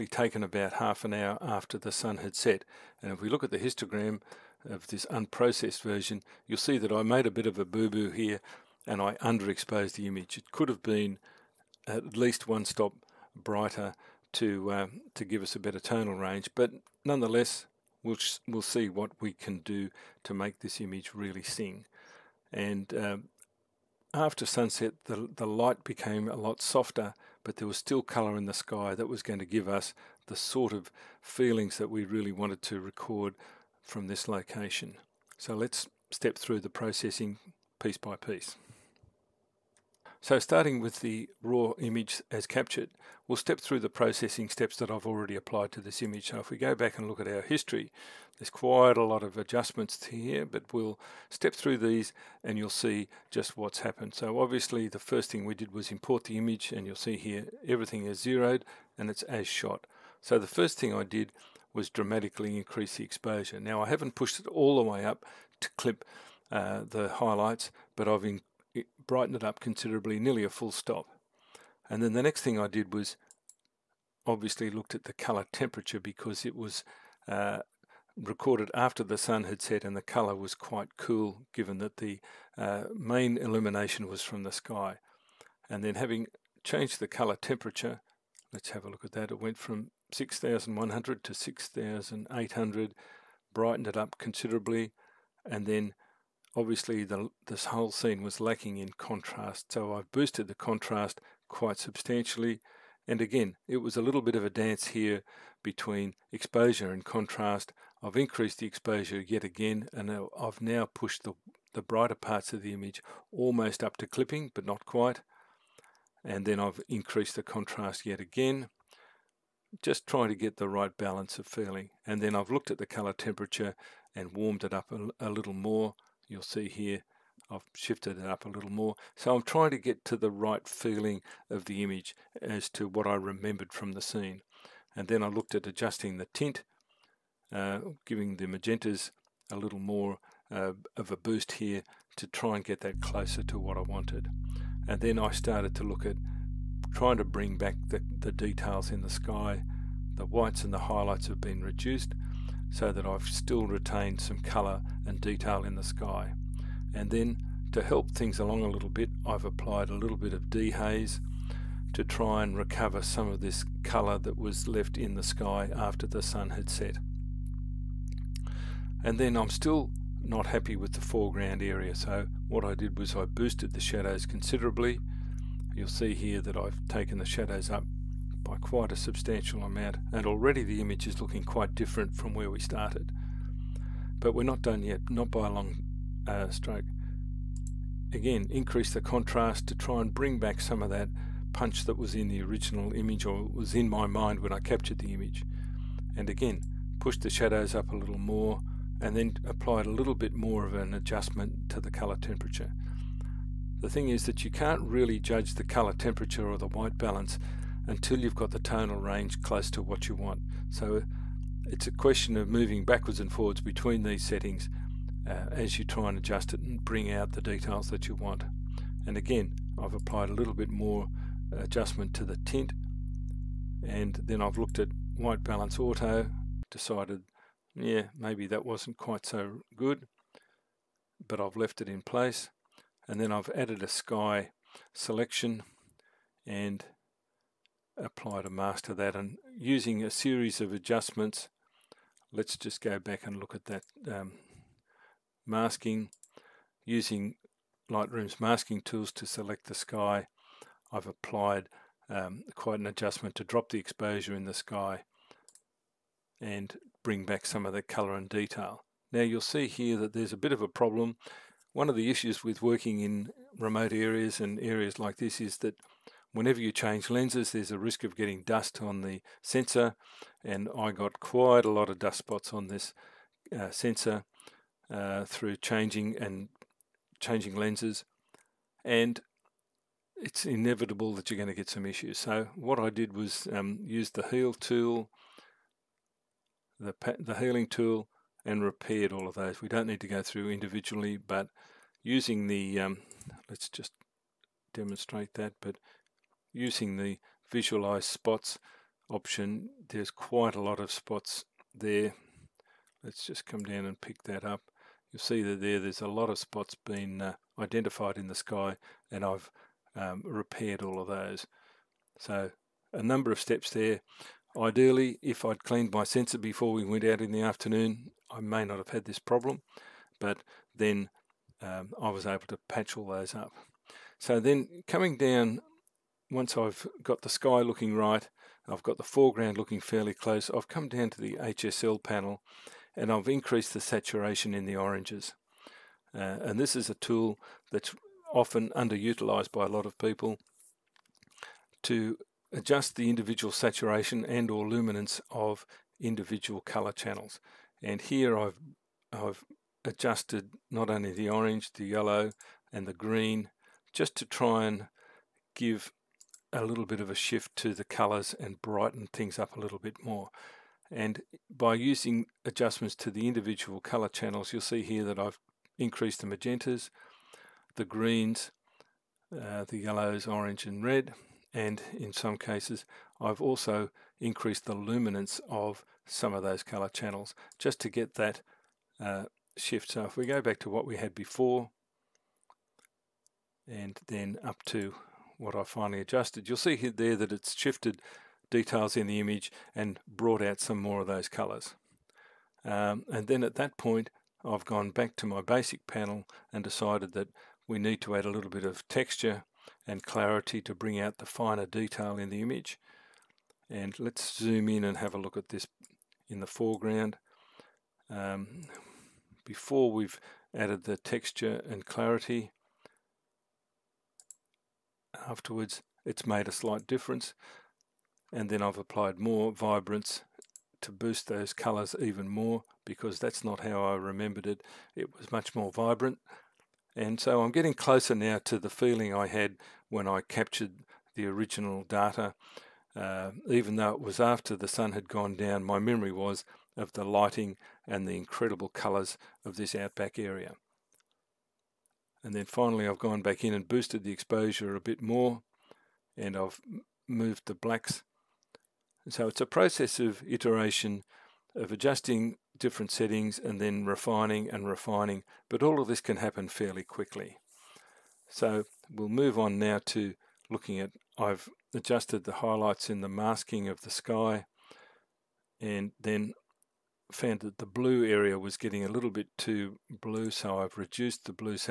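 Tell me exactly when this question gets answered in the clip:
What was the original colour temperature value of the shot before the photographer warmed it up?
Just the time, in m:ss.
1:30.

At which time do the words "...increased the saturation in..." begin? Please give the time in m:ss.
5:33.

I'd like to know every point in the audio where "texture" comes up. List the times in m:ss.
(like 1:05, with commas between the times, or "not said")
6:38, 6:50.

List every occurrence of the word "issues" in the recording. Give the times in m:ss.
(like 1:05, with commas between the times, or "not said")
4:22, 4:41.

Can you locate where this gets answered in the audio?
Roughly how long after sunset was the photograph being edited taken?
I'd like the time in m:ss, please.
0:00.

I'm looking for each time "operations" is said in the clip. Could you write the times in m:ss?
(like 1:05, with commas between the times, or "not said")
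not said.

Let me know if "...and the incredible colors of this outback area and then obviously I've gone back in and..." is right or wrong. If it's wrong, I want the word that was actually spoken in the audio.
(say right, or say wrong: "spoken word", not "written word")
wrong: "finally", not "obviously".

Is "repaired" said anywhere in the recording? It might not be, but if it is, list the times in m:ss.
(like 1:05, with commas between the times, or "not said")
4:48, 5:10.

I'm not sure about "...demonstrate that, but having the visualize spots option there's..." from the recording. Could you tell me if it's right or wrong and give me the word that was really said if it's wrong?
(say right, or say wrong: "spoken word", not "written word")
wrong: "using", not "having".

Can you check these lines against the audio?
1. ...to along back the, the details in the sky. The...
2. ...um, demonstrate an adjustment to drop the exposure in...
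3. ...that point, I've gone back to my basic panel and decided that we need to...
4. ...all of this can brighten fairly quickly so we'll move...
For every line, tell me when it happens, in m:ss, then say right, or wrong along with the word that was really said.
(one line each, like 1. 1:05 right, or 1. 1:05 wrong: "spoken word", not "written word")
1. 2:27 wrong: "bring", not "along"
2. 4:12 wrong: "quite", not "demonstrate"
3. 6:33 right
4. 7:35 wrong: "happen", not "brighten".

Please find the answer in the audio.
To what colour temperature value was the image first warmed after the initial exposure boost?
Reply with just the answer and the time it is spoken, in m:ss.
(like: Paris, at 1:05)
6800, at 1:31.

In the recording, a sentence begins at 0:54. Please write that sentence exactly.
So obviously the first thing we did was import the image and you'll see here everything is zeroed and it's as shot.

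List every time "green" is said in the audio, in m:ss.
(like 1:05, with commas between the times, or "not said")
5:52, 6:07.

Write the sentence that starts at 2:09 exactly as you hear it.
So I'm trying to get to the right feeling of the image as to what I remembered from the scene.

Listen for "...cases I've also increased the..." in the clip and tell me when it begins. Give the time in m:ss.
6:12.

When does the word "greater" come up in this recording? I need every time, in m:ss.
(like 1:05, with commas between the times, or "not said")
not said.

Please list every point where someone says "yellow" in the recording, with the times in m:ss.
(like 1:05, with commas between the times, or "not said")
5:51, 6:09.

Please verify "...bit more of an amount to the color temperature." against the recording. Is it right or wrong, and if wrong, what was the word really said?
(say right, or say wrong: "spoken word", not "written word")
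wrong: "adjustment", not "amount".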